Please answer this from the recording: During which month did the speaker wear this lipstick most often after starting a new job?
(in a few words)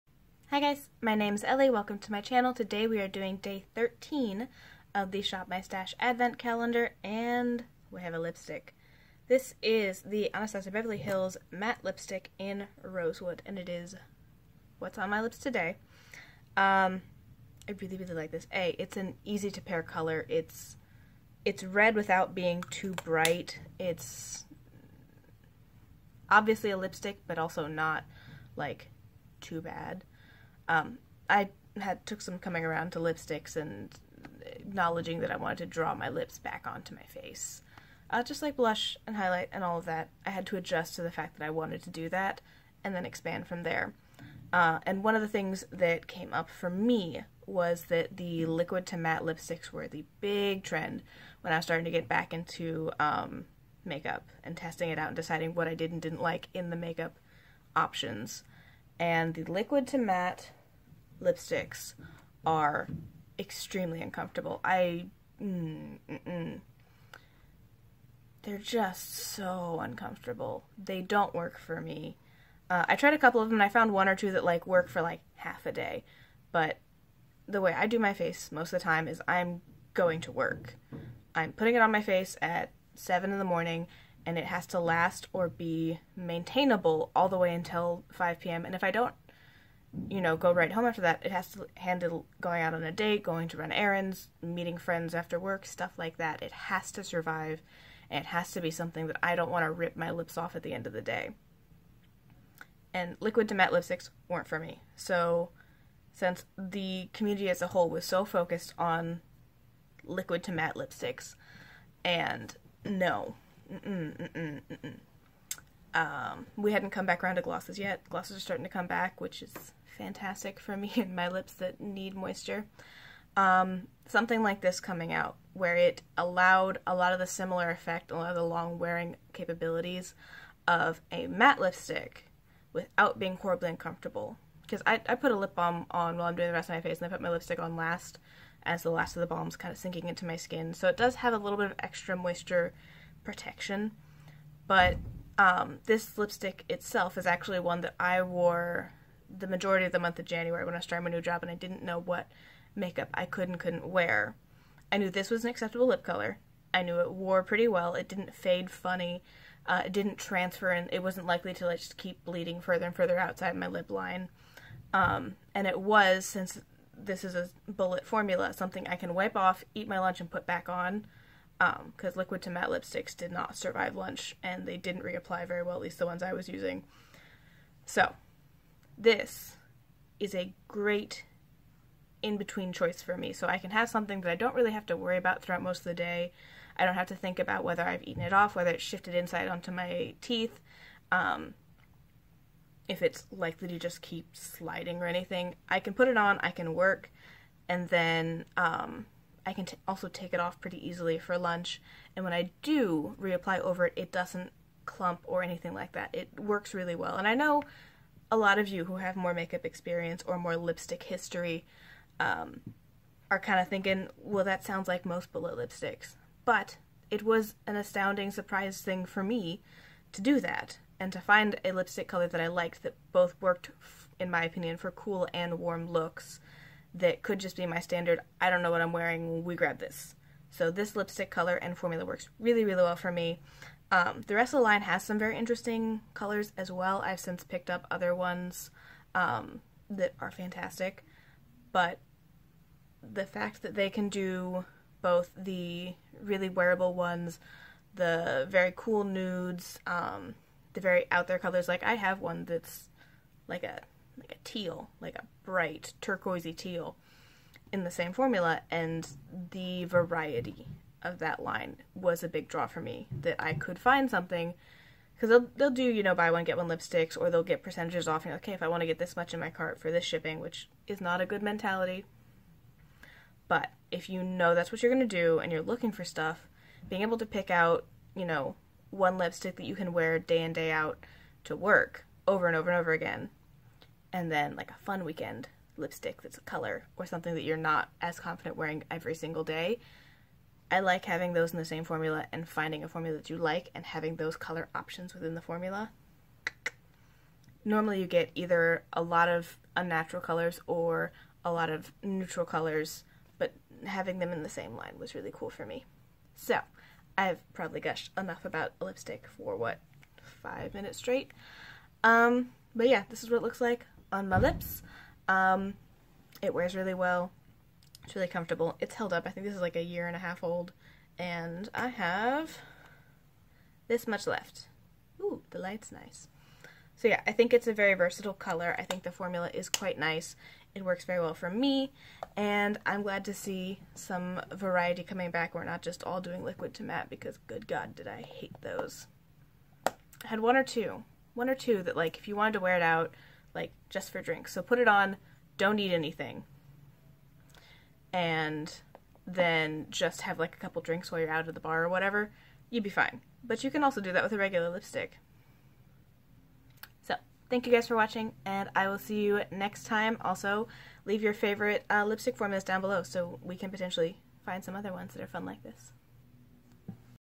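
January.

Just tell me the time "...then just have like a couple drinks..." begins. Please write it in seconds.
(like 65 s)
349 s.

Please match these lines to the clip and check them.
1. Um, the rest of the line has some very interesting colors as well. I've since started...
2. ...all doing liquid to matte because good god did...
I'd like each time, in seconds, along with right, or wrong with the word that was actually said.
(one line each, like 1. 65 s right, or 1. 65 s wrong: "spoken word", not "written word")
1. 233 s wrong: "picked", not "started"
2. 336 s right.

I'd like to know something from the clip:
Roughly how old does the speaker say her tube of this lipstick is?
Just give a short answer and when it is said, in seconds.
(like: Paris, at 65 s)
A year and a half, at 319 s.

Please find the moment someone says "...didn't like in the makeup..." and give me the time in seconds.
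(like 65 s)
56 s.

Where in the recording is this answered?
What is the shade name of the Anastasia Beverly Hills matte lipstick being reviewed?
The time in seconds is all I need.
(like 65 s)
12 s.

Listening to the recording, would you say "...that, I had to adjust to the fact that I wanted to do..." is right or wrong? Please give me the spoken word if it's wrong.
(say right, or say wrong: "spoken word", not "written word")
right.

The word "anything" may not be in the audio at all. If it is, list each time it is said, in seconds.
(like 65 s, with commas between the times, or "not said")
195 s, 205 s, 345 s.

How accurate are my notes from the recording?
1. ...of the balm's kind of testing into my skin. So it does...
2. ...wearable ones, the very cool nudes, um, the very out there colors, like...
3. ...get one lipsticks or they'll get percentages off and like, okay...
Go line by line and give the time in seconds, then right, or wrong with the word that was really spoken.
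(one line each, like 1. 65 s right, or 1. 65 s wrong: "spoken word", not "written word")
1. 139 s wrong: "sinking", not "testing"
2. 246 s right
3. 266 s right.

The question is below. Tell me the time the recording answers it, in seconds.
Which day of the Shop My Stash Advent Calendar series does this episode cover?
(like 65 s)
3 s.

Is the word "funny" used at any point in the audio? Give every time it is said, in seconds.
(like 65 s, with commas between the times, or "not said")
158 s.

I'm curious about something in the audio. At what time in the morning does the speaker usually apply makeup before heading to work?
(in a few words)
7.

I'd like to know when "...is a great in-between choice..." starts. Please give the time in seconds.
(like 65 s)
180 s.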